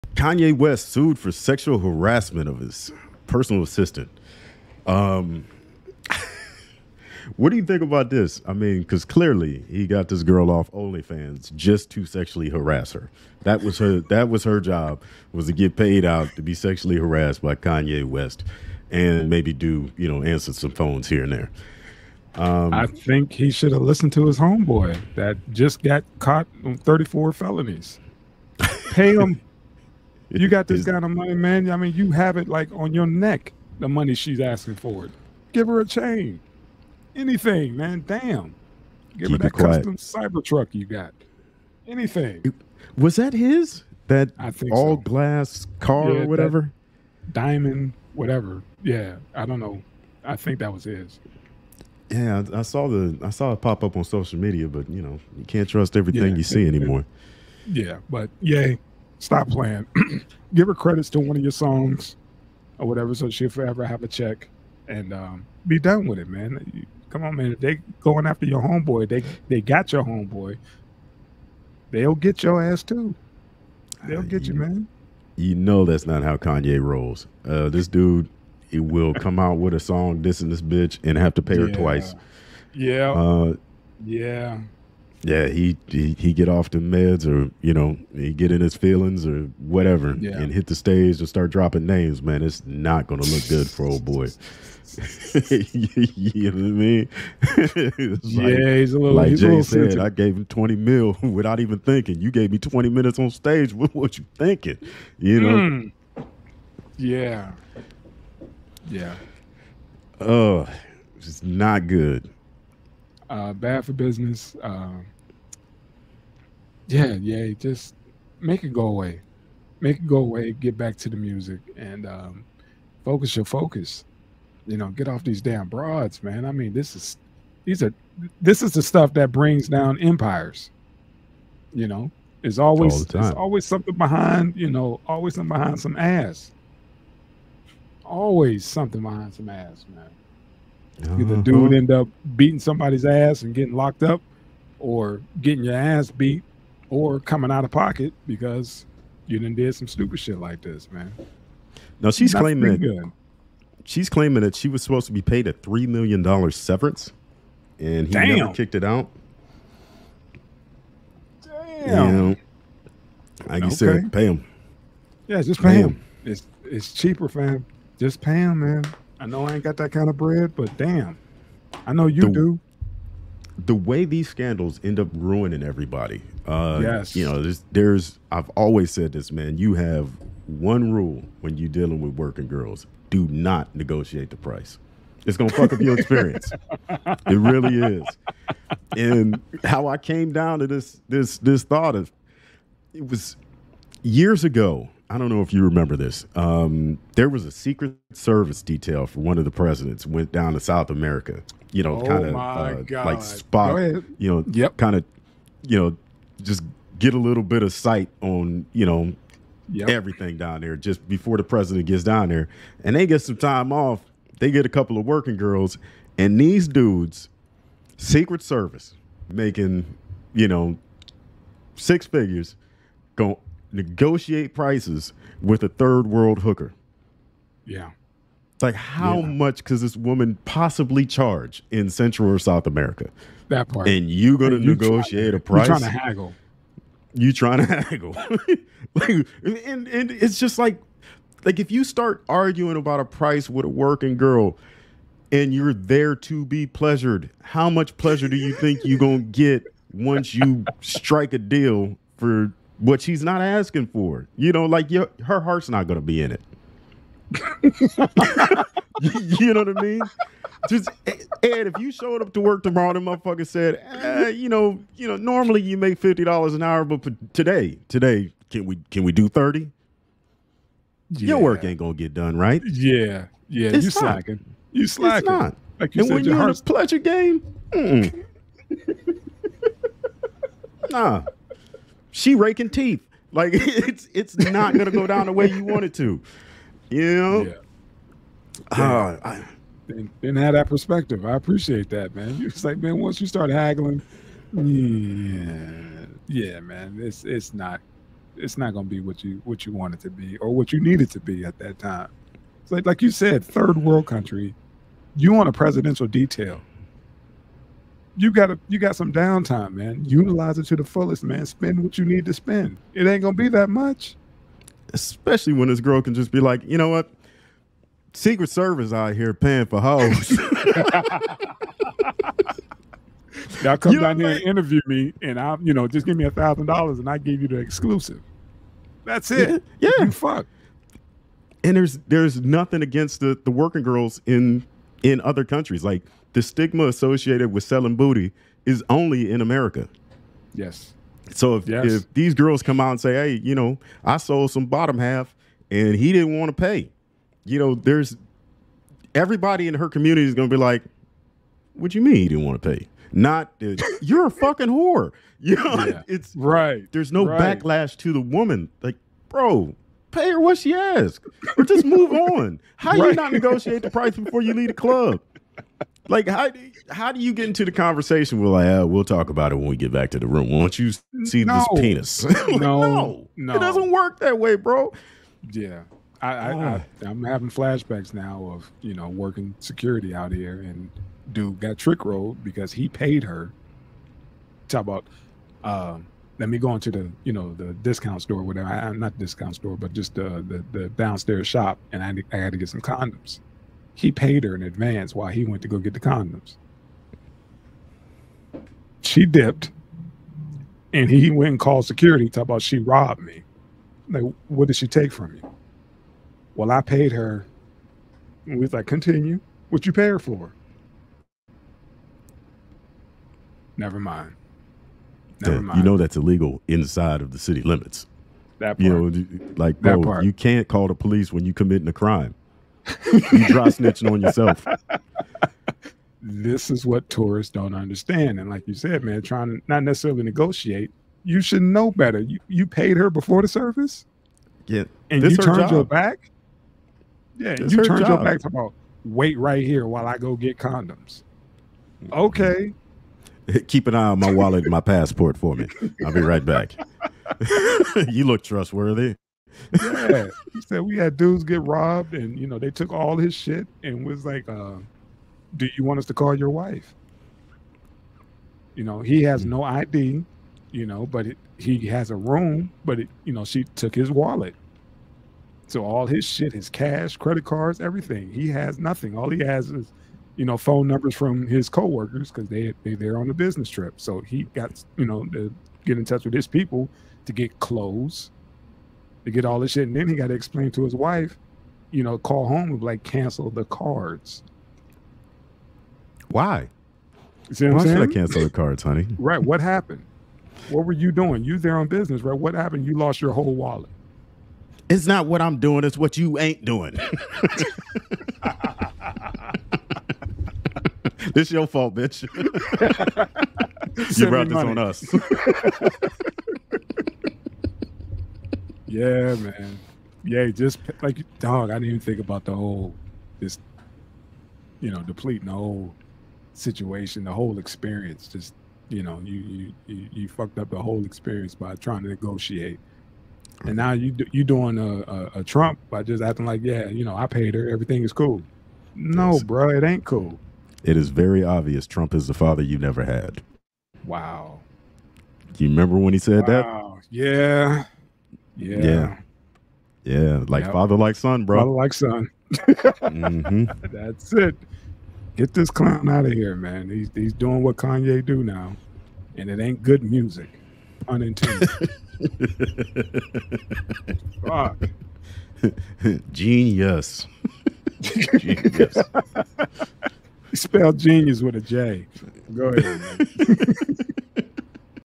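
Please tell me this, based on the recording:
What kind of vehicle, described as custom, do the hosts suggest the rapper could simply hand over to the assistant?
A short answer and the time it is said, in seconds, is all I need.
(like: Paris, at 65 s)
Cybertruck, at 39 s.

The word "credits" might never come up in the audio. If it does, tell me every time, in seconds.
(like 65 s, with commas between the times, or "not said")
60 s, 467 s.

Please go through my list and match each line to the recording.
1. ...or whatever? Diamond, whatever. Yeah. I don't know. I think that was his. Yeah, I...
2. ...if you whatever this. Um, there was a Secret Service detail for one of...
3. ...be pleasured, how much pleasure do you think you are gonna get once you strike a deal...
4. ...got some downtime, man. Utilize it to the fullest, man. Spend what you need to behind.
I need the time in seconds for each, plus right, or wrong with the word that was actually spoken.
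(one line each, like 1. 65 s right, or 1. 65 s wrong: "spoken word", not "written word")
1. 46 s right
2. 195 s wrong: "remember", not "whatever"
3. 246 s right
4. 308 s wrong: "spend", not "behind".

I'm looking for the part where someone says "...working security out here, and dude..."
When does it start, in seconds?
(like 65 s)
379 s.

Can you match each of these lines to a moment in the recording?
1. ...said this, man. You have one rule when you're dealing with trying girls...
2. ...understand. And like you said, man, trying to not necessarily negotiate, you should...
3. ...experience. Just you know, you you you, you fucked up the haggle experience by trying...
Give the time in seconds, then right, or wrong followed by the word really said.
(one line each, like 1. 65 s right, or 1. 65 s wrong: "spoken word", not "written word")
1. 178 s wrong: "working", not "trying"
2. 427 s right
3. 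517 s wrong: "whole", not "haggle".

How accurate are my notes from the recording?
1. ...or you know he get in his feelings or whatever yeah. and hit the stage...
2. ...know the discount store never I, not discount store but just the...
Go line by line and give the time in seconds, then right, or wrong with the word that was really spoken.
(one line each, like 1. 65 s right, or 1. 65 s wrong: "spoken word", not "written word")
1. 87 s right
2. 387 s wrong: "whatever", not "never".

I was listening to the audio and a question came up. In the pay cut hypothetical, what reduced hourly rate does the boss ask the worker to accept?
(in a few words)
$30.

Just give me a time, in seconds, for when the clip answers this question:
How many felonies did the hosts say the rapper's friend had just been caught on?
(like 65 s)
26 s.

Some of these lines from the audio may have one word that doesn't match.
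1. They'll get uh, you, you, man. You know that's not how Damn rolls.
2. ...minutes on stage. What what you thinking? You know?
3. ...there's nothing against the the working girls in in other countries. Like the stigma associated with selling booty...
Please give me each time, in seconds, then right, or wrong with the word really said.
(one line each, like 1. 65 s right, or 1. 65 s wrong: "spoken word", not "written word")
1. 74 s wrong: "Kanye", not "Damn"
2. 102 s right
3. 332 s right.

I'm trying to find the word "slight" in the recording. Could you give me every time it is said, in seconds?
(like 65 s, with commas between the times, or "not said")
not said.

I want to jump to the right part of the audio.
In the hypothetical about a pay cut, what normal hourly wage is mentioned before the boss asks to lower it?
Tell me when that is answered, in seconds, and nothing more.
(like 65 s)
265 s.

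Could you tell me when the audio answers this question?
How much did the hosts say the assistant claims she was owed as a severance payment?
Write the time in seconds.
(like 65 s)
155 s.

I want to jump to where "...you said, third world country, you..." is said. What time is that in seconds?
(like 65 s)
303 s.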